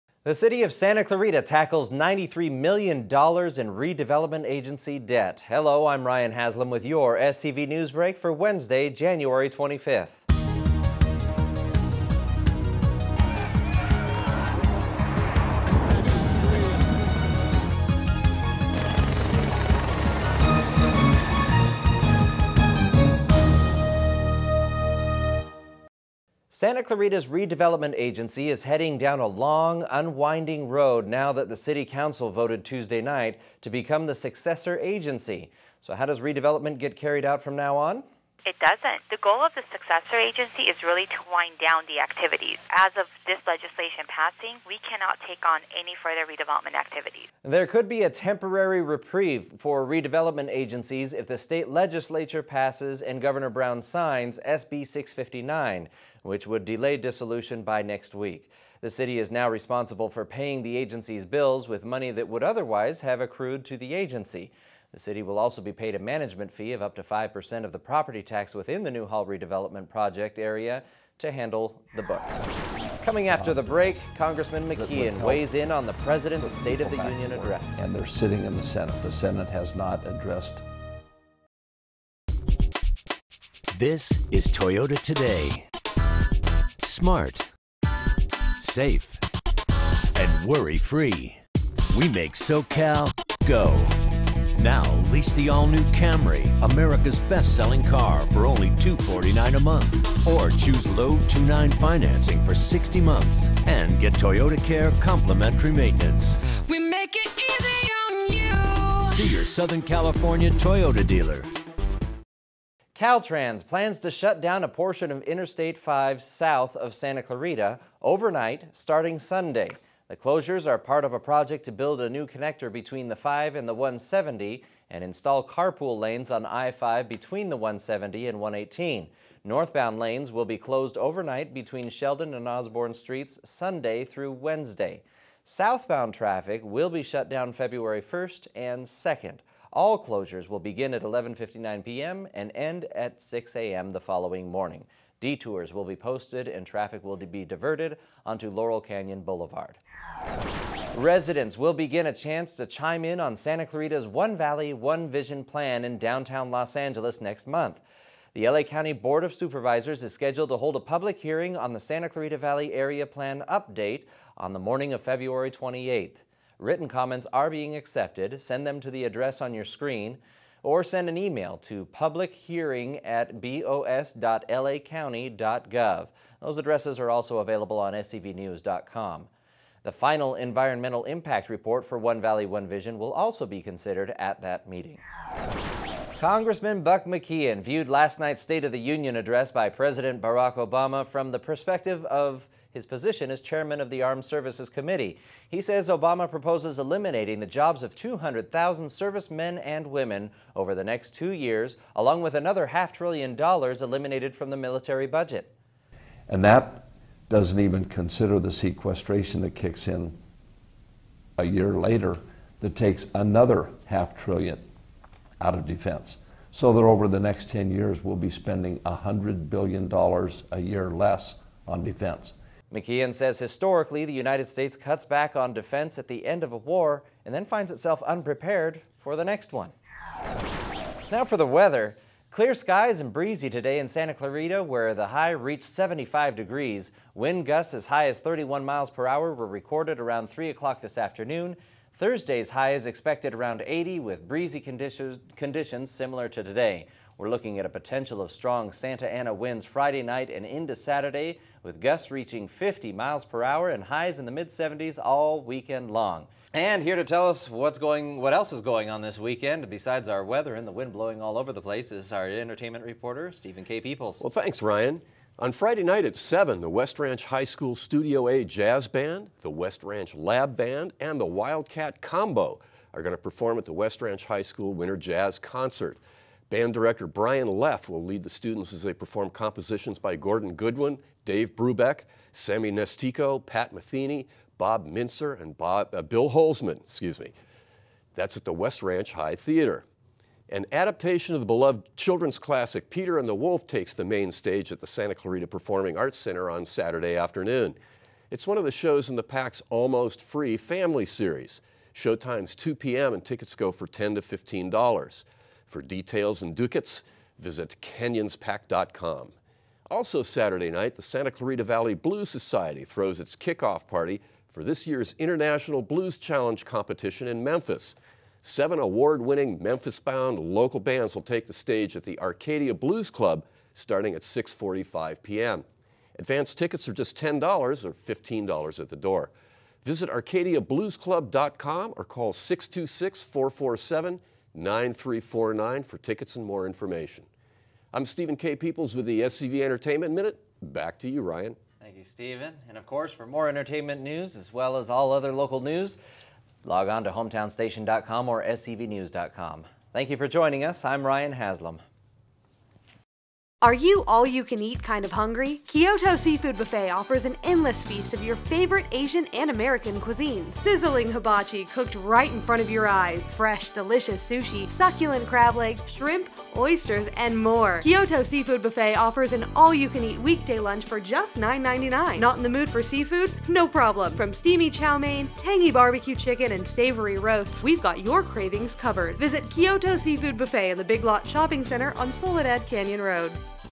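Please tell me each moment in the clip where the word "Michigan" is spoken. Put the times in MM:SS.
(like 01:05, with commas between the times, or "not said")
not said.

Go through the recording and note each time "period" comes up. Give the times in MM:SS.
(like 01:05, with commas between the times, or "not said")
not said.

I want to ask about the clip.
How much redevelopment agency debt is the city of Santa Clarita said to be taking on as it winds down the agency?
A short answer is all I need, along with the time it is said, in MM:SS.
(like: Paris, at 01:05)
$93 million, at 00:01.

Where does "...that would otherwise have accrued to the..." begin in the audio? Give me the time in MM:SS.
01:02.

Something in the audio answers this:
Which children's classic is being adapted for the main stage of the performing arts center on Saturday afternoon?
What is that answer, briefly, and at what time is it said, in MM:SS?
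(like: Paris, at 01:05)
Peter and the Wolf, at 04:52.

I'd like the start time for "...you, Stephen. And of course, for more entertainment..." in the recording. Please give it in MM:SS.
05:41.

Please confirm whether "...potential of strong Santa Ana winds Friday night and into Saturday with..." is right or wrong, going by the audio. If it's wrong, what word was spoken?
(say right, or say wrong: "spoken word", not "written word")
right.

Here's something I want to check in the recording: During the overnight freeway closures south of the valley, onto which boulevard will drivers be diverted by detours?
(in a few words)
Laurel Canyon Boulevard.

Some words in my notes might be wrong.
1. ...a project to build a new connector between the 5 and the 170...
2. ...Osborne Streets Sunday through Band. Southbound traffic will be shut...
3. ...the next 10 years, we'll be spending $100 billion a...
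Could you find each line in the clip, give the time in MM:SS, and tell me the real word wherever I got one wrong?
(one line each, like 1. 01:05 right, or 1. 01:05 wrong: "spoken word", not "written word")
1. 02:01 right
2. 02:12 wrong: "Wednesday", not "Band"
3. 03:37 right.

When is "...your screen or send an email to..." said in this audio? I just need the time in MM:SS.
02:49.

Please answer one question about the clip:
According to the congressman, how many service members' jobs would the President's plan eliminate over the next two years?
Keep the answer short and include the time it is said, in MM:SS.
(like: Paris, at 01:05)
200,000, at 03:17.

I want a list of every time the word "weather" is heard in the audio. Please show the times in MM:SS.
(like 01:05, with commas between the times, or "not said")
03:51, 04:20.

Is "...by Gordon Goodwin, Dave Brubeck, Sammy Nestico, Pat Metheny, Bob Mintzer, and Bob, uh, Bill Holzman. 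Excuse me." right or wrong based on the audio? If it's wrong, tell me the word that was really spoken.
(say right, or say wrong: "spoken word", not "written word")
right.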